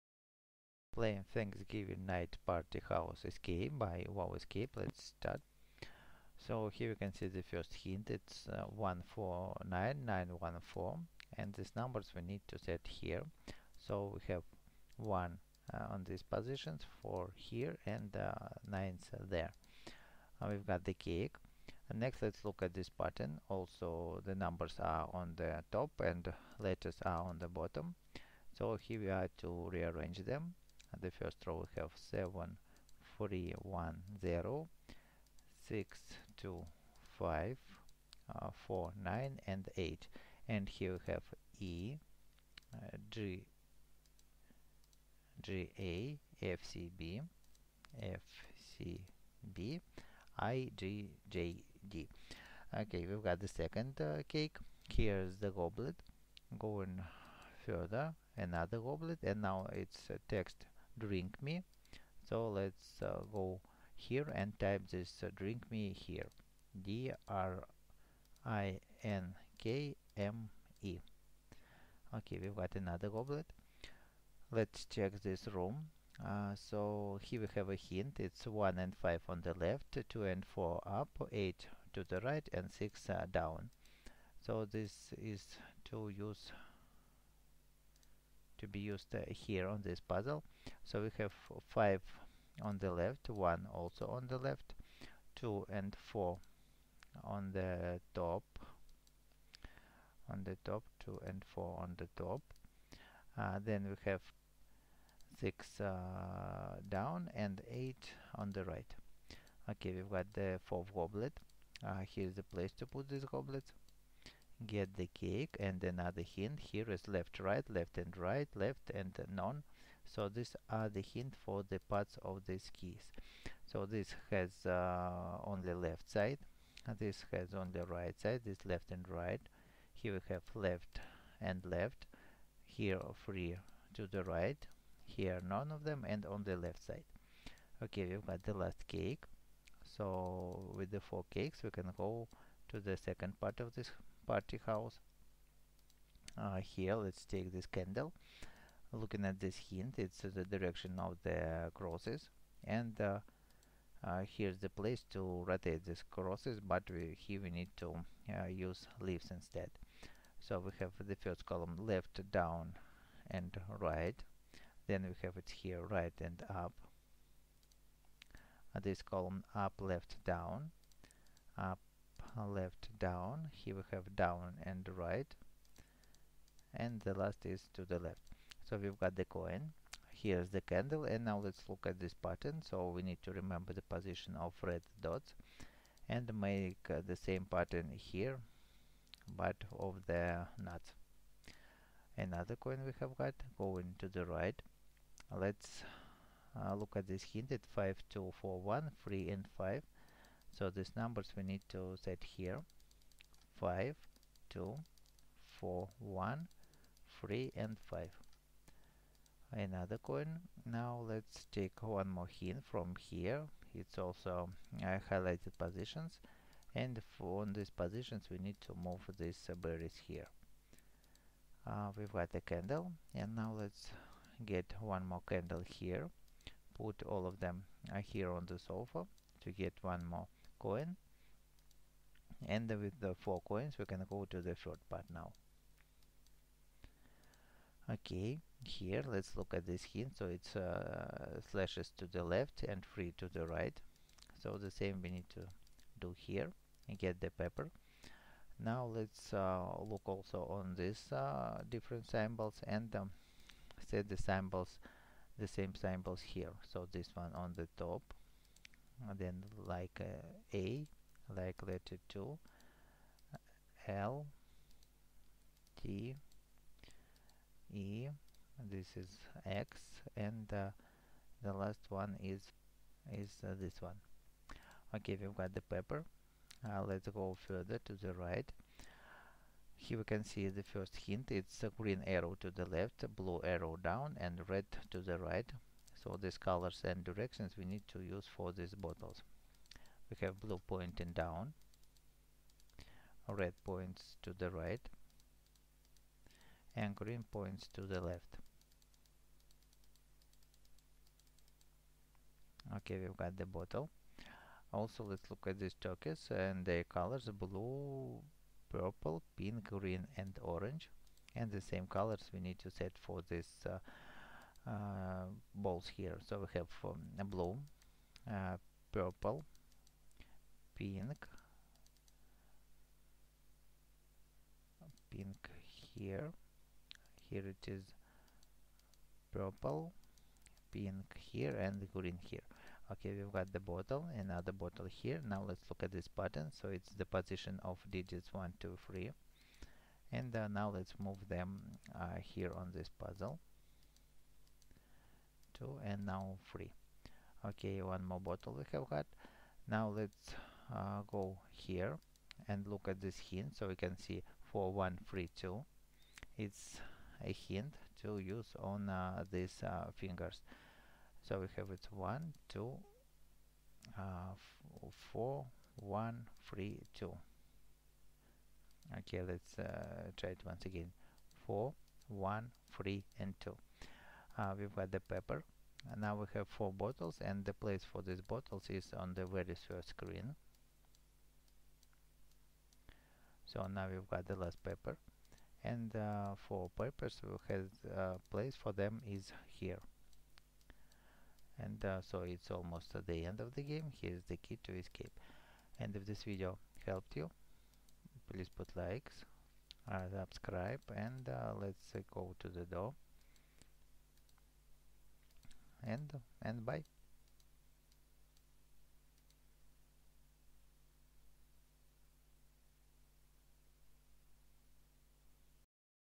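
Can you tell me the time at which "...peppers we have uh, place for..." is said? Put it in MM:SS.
06:26.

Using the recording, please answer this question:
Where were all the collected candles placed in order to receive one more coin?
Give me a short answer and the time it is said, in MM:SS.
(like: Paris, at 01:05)
on the sofa, at 03:48.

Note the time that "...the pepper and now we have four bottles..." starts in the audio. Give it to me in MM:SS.
06:14.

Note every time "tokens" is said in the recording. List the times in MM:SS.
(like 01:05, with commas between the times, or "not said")
05:05.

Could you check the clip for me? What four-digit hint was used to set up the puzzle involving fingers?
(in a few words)
4132.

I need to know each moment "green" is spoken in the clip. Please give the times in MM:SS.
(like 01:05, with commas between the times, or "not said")
04:41, 04:56, 05:09, 05:31.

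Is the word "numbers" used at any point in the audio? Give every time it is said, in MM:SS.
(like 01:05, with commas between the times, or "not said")
00:11, 00:24, 03:20.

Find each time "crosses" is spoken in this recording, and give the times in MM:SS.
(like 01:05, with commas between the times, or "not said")
02:31, 02:36.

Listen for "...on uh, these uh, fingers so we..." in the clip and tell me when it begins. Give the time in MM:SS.
05:58.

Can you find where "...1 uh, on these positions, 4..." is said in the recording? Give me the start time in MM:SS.
00:14.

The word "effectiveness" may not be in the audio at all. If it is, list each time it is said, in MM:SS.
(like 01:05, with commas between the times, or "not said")
not said.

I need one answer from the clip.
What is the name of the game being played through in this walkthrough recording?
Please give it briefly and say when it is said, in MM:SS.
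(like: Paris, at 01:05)
Thanksgiving Night Party House Escape, at 00:01.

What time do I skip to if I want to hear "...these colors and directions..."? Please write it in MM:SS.
04:46.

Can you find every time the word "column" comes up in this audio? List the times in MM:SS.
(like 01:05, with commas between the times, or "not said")
02:41, 02:49.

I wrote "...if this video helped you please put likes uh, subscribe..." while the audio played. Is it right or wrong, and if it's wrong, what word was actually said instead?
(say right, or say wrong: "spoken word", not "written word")
right.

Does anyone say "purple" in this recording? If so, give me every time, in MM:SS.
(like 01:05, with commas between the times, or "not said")
05:08, 05:18, 05:29.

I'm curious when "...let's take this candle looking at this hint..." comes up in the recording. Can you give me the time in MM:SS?
02:26.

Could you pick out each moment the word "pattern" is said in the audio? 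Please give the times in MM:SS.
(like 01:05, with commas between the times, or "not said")
00:22, 03:02, 03:07, 05:36.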